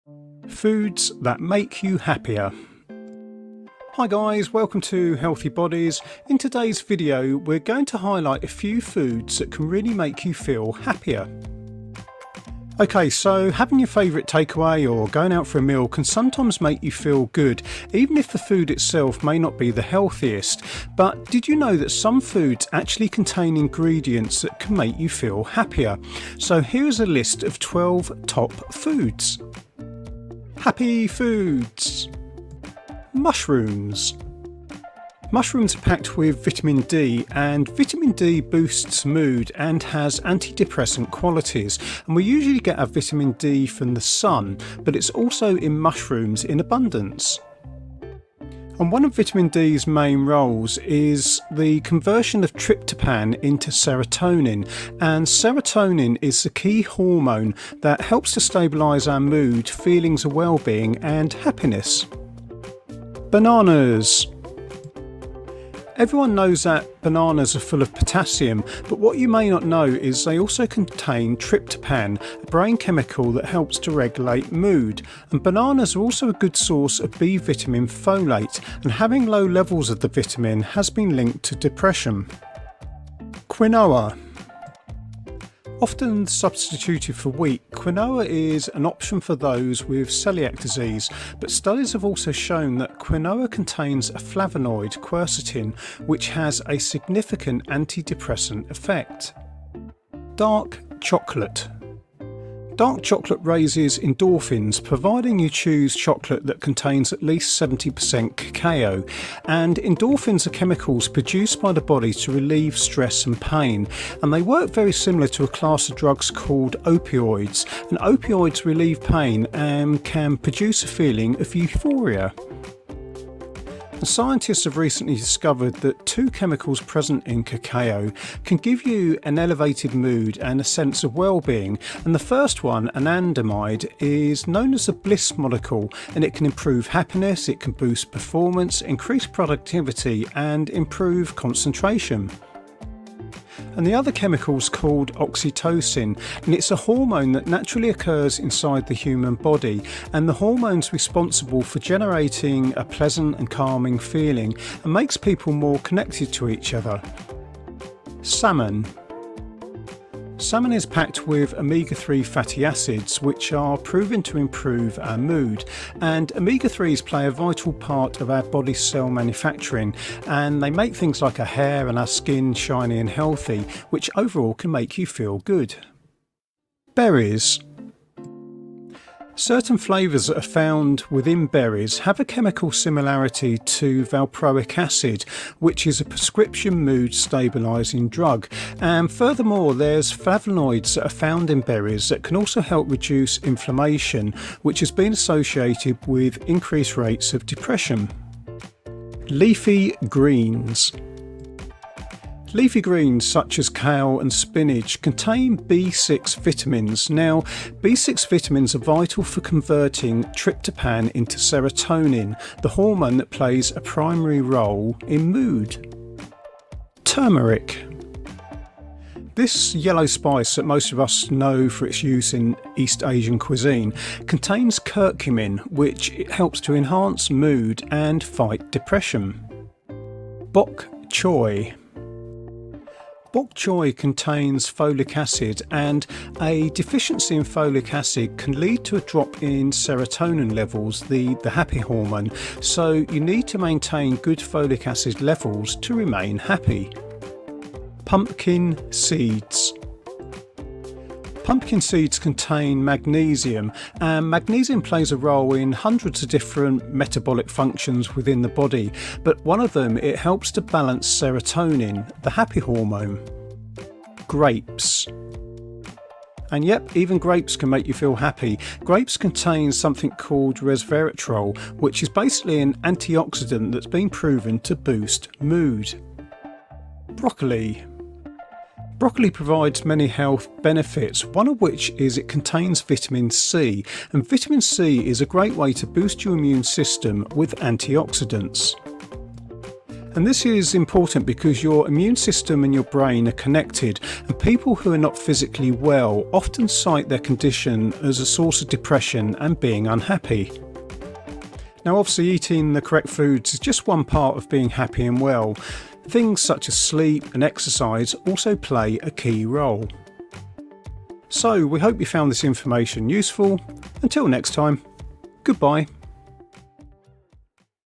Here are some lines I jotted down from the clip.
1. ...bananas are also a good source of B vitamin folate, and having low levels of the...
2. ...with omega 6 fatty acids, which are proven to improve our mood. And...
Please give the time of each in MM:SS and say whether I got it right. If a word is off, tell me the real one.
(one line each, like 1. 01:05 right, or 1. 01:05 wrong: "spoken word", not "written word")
1. 01:15 right
2. 02:41 wrong: "3", not "6".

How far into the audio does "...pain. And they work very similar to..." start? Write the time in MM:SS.
01:53.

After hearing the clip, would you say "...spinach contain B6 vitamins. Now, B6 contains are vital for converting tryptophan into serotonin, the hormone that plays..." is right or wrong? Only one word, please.
wrong.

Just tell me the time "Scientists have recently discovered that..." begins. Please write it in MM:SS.
02:04.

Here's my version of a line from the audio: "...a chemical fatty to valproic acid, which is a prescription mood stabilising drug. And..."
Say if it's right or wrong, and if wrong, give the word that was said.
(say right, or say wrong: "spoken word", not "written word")
wrong: "similarity", not "fatty".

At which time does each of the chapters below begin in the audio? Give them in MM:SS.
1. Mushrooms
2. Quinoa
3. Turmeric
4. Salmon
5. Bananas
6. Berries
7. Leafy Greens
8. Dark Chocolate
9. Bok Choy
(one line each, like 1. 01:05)
1. 00:32
2. 01:23
3. 03:36
4. 02:38
5. 01:04
6. 02:56
7. 03:18
8. 01:40
9. 03:50.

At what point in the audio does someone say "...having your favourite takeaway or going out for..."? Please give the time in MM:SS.
00:13.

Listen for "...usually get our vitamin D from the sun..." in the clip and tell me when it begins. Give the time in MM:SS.
00:42.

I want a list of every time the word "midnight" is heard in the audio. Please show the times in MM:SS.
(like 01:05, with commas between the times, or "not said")
not said.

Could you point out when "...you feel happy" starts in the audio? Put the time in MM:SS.
04:27.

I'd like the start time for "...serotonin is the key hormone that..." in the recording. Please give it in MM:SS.
00:55.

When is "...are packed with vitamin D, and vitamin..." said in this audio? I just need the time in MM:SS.
00:35.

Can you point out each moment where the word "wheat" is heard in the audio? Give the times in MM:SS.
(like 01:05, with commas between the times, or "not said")
01:27.